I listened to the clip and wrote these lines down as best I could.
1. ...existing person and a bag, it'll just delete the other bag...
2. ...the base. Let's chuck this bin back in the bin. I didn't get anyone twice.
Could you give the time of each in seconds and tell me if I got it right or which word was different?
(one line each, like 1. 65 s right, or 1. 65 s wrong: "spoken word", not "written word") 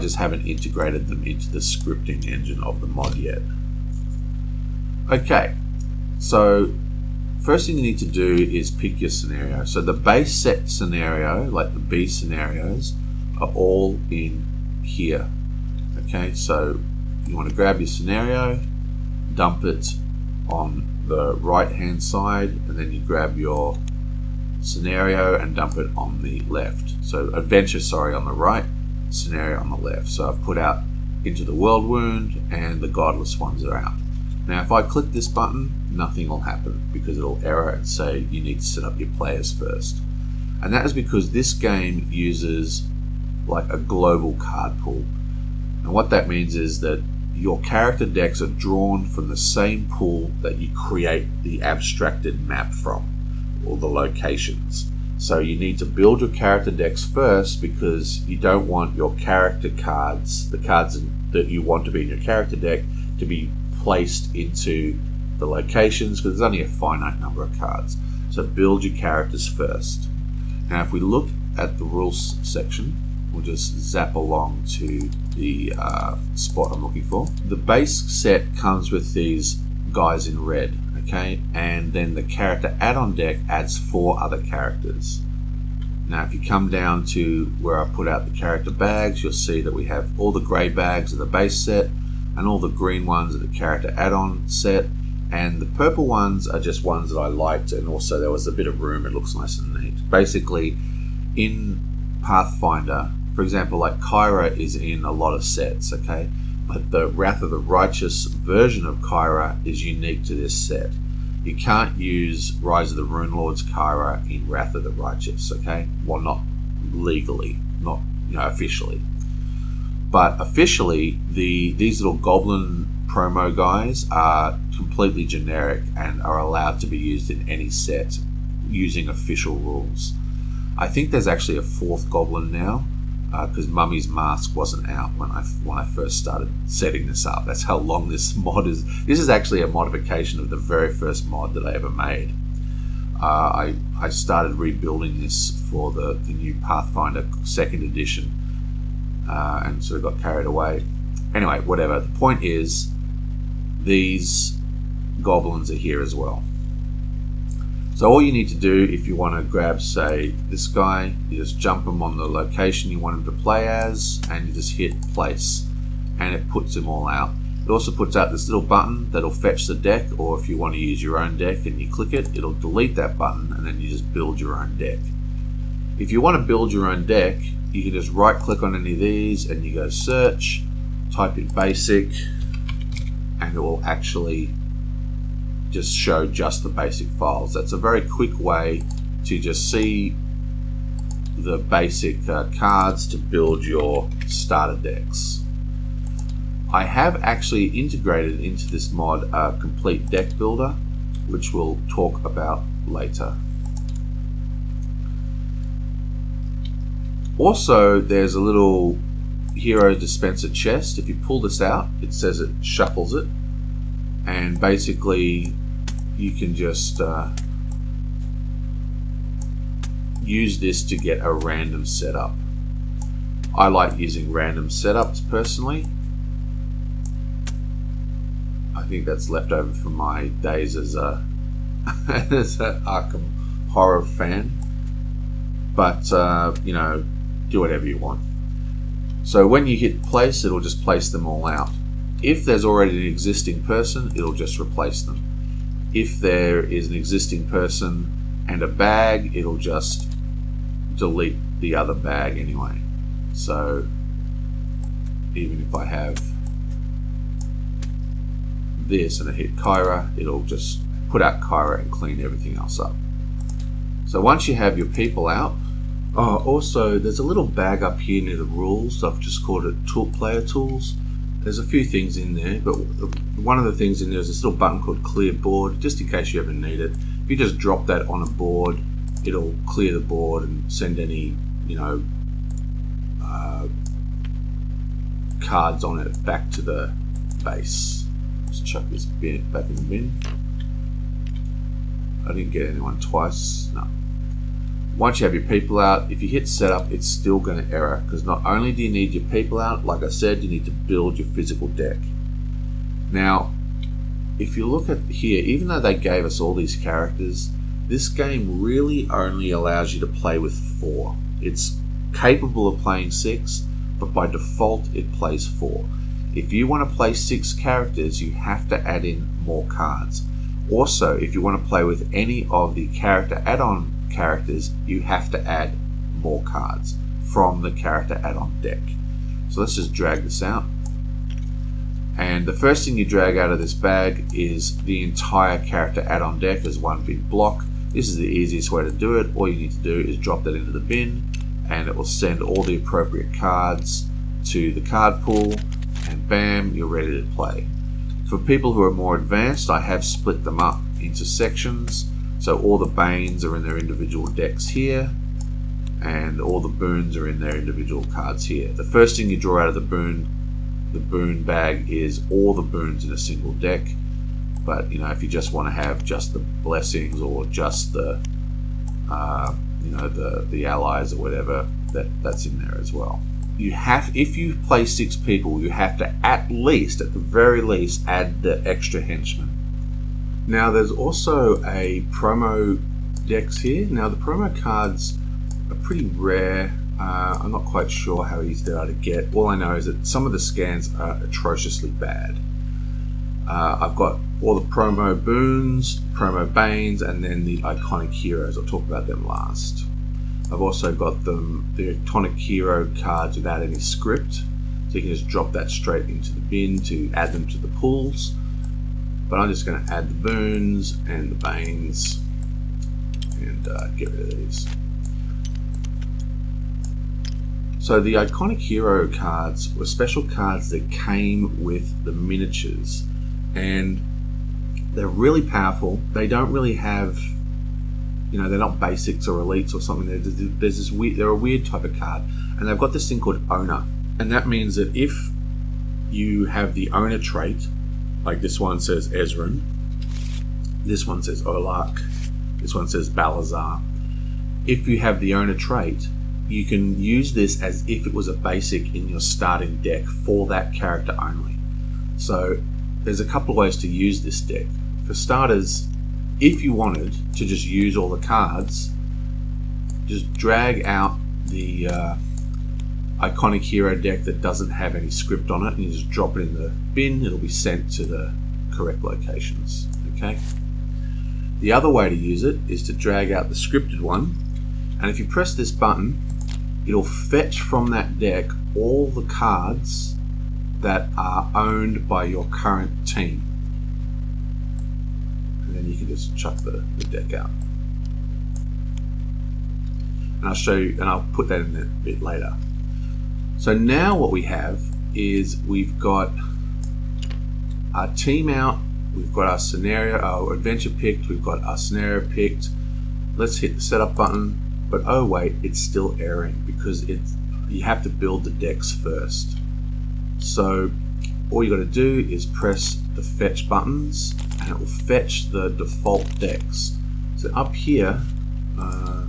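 1. 246 s right
2. 286 s right.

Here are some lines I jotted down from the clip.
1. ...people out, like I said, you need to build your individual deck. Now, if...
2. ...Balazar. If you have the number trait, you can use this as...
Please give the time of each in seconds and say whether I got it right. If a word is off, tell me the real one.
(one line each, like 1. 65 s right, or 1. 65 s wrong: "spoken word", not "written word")
1. 299 s wrong: "physical", not "individual"
2. 443 s wrong: "owner", not "number".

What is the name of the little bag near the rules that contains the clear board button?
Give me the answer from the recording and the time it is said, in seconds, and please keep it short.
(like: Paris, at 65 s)
Player Tools, at 269 s.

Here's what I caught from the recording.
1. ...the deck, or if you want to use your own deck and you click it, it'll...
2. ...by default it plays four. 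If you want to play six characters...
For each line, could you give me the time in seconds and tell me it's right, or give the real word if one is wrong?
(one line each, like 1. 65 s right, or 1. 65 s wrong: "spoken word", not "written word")
1. 169 s right
2. 314 s right.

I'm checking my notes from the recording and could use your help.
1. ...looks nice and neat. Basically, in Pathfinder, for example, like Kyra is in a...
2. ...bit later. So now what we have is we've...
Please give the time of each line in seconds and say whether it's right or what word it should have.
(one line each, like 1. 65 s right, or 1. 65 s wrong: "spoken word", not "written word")
1. 99 s right
2. 492 s right.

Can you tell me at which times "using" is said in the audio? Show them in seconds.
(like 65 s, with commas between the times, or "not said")
128 s, 223 s.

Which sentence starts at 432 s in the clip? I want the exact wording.
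And they've got this thing called owner.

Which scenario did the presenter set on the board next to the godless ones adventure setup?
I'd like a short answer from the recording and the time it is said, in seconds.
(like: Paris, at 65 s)
World Wound, at 31 s.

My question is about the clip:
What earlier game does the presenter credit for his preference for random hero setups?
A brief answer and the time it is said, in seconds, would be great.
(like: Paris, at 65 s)
Arkham Horror, at 232 s.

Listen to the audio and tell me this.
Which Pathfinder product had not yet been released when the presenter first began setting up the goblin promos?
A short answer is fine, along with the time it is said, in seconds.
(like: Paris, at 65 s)
Mummy's Mask, at 133 s.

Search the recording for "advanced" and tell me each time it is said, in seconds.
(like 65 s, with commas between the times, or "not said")
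349 s.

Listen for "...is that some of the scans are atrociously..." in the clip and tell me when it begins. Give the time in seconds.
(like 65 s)
389 s.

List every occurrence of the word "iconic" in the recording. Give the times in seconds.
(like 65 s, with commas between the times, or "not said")
397 s, 401 s, 418 s, 463 s.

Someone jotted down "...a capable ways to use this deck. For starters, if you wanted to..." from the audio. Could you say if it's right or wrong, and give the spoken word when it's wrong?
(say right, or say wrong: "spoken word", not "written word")
wrong: "couple", not "capable".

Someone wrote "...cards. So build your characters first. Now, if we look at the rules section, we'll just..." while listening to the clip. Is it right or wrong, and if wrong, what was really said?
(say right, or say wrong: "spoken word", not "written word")
right.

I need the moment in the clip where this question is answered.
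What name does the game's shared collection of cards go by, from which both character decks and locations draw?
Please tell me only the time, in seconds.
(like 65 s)
43 s.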